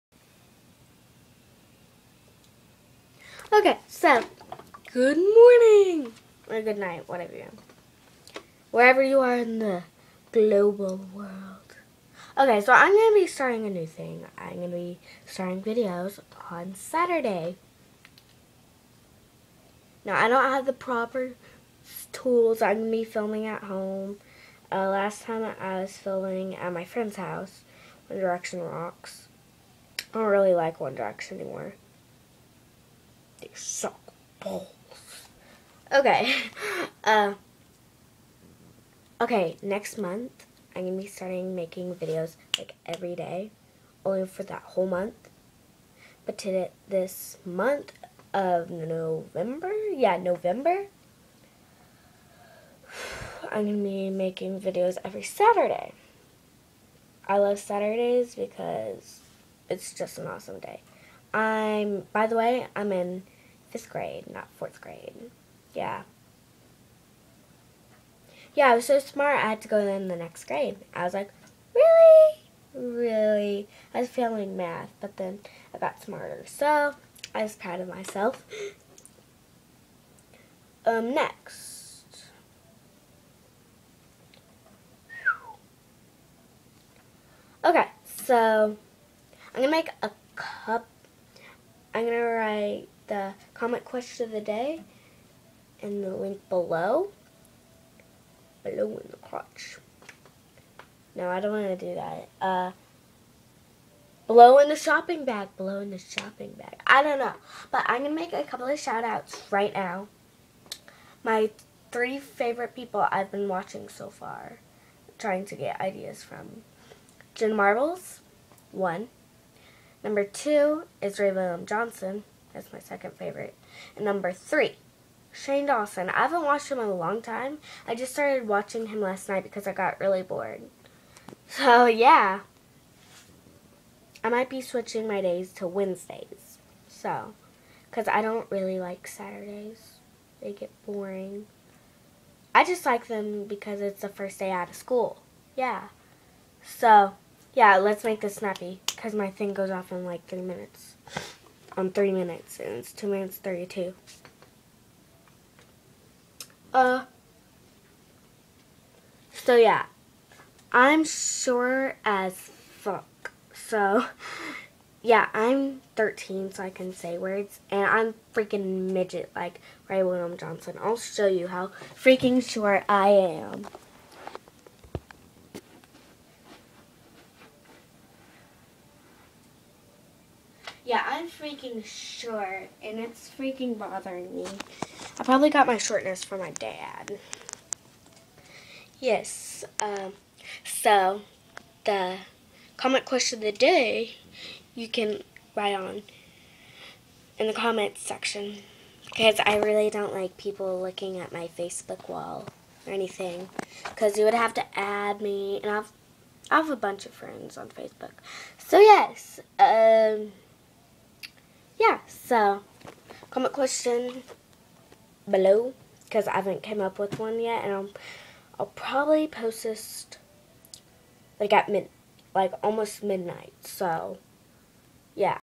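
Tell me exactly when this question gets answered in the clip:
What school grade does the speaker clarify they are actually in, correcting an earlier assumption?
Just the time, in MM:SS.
01:03.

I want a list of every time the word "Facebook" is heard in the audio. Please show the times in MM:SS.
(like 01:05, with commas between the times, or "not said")
03:21, 03:27.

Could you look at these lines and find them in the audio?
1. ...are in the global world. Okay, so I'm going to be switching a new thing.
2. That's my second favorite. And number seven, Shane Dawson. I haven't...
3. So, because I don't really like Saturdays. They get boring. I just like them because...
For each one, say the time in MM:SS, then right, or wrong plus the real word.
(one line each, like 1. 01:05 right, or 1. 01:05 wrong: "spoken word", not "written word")
1. 00:09 wrong: "starting", not "switching"
2. 02:02 wrong: "three", not "seven"
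3. 02:16 right.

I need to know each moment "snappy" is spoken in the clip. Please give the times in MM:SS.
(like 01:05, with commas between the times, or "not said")
02:28.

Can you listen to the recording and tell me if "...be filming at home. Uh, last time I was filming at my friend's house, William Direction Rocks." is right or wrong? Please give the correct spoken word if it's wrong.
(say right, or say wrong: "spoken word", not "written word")
wrong: "One", not "William".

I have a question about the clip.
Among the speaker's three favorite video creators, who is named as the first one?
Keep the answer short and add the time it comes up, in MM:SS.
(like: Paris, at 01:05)
Jenna Marbles, at 01:57.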